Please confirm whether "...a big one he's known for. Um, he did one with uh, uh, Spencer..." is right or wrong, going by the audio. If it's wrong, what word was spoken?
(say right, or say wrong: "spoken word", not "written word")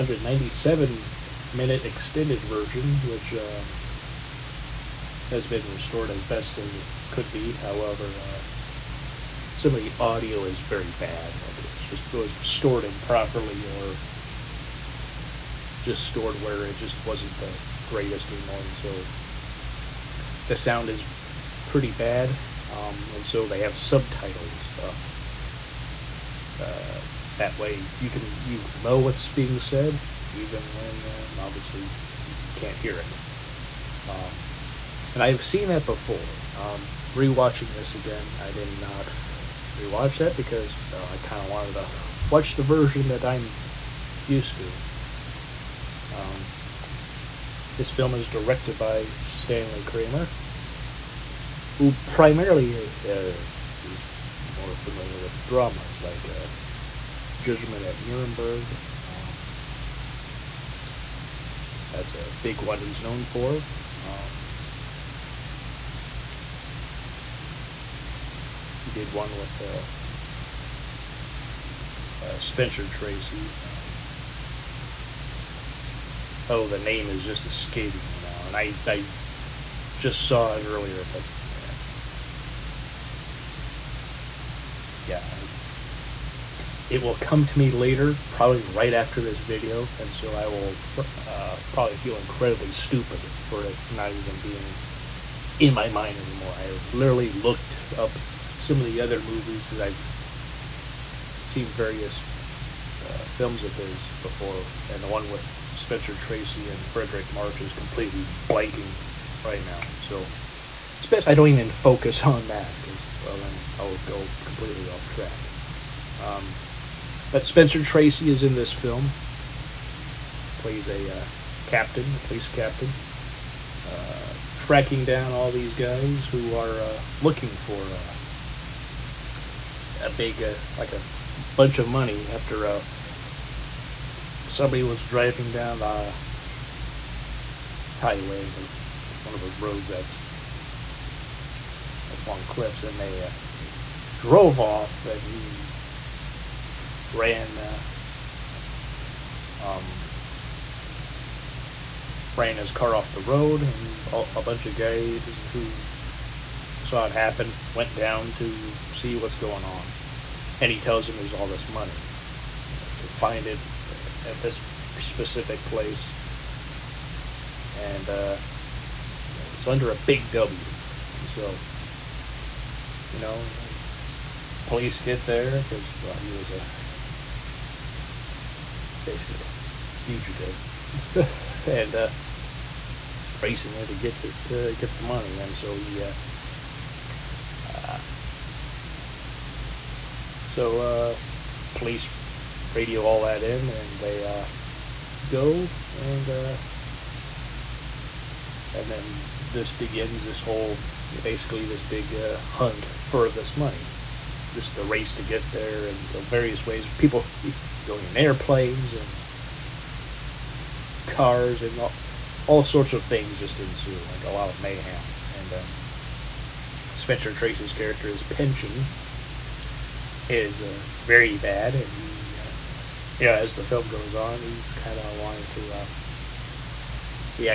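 right.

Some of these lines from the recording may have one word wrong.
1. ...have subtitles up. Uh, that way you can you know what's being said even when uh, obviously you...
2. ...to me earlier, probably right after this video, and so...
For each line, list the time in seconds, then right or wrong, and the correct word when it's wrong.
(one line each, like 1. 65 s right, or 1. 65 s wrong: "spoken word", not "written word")
1. 23 s right
2. 87 s wrong: "later", not "earlier".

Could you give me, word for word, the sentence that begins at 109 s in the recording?
So it's best I don't even focus on that because, well, then I'll go completely off track.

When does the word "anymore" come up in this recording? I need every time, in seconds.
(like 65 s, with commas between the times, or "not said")
18 s, 96 s.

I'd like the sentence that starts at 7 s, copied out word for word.
However, uh, some of the audio is very bad.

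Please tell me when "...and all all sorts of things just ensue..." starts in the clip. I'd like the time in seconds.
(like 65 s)
211 s.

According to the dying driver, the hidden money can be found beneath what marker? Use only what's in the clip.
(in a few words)
A big W.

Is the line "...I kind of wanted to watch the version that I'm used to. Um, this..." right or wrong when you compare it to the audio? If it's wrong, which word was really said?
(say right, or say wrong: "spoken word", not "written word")
right.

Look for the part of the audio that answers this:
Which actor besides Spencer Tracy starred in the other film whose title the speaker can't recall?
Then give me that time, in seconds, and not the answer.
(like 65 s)
106 s.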